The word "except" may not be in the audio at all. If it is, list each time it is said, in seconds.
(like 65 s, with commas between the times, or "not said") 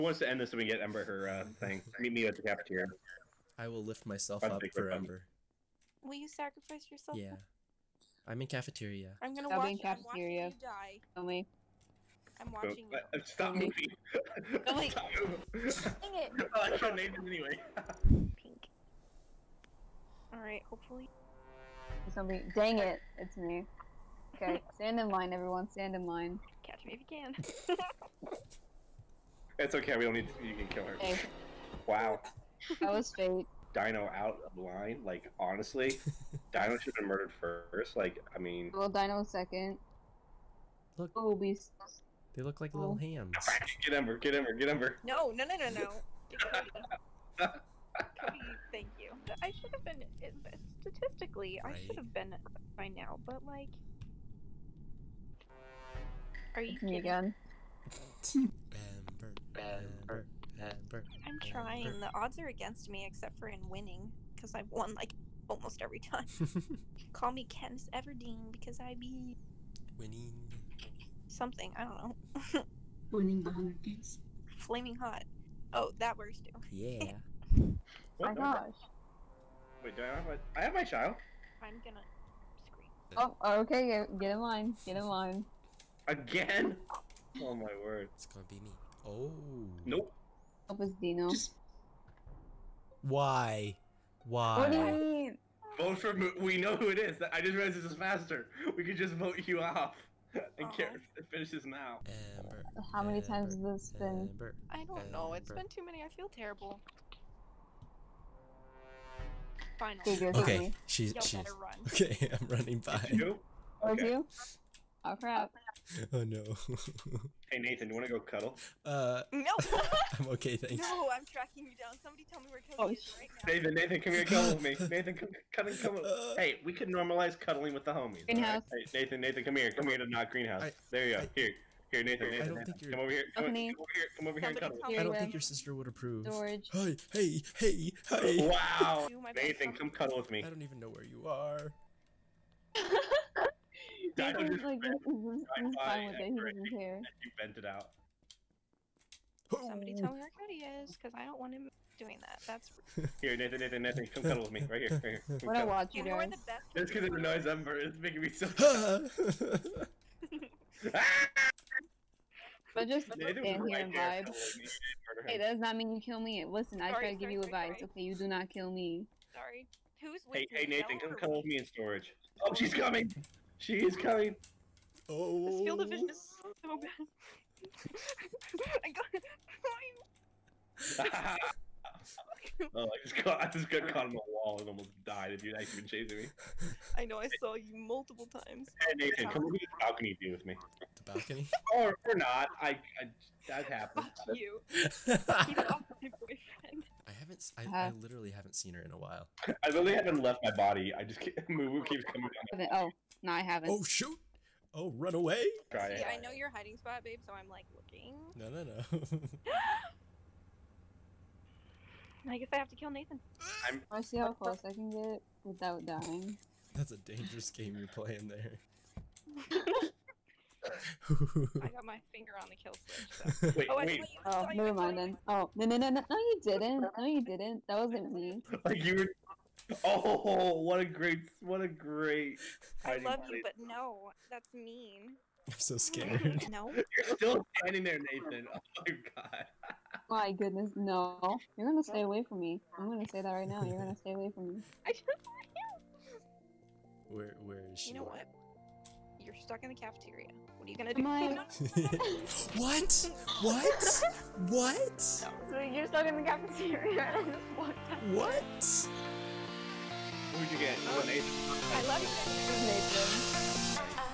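63 s.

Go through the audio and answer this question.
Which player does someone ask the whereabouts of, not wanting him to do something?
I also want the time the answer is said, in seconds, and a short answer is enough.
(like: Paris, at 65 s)
Cody, at 150 s.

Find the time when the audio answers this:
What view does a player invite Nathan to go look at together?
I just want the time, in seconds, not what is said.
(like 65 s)
189 s.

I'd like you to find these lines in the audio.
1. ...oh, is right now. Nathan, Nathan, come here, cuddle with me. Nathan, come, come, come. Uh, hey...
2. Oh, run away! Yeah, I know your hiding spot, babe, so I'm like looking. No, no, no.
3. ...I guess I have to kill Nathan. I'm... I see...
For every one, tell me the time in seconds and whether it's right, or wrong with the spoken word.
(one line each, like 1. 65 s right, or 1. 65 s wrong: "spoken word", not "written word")
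1. 122 s right
2. 204 s right
3. 212 s right.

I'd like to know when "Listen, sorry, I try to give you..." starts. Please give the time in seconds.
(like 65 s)
166 s.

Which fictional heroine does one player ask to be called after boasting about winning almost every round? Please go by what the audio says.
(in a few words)
Katniss Everdeen.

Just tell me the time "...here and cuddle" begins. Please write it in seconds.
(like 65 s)
134 s.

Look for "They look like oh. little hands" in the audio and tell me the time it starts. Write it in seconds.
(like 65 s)
42 s.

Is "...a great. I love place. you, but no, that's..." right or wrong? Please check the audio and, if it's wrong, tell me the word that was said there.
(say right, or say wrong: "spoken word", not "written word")
right.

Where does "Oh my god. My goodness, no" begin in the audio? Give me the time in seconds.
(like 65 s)
238 s.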